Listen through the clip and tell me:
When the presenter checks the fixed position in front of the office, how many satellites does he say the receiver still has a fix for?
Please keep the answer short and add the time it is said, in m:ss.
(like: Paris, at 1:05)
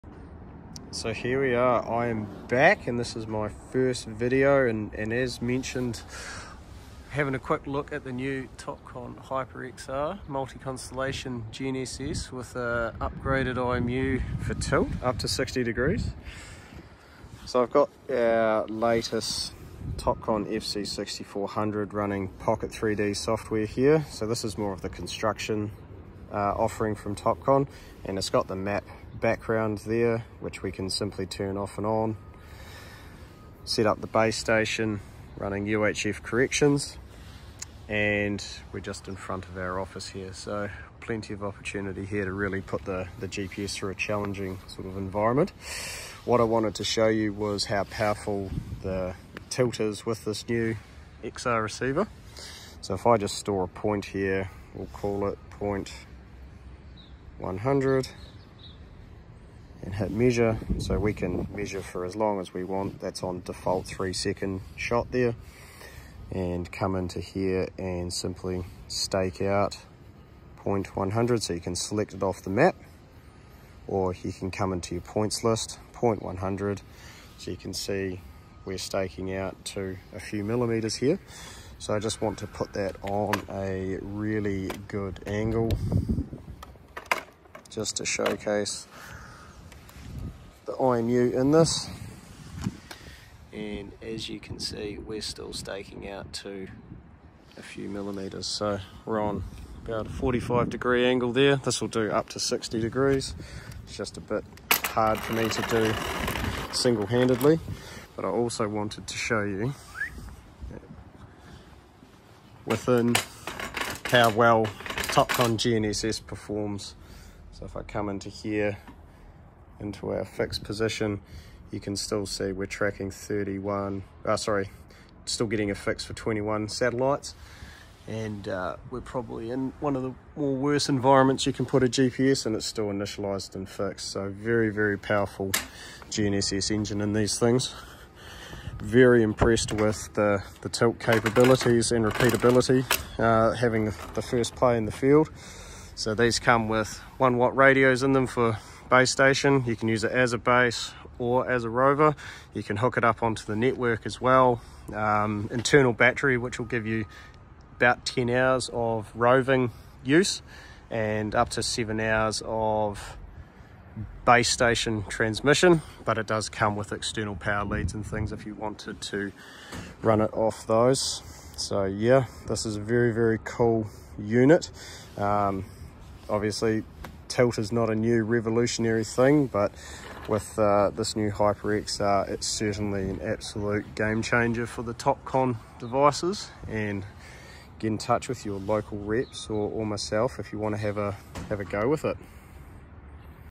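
21, at 2:06.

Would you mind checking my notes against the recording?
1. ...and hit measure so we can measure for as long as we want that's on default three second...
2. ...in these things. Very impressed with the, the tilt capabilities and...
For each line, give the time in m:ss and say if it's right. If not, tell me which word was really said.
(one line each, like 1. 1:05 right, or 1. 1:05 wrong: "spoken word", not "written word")
1. 0:59 right
2. 2:16 right.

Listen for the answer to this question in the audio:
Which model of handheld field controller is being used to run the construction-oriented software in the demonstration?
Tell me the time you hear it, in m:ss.
0:20.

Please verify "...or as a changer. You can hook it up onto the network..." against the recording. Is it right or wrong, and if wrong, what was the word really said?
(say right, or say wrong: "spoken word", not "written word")
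wrong: "rover", not "changer".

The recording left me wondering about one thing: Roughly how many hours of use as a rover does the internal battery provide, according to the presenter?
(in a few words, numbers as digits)
10 hours.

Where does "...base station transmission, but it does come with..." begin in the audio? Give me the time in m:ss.
2:44.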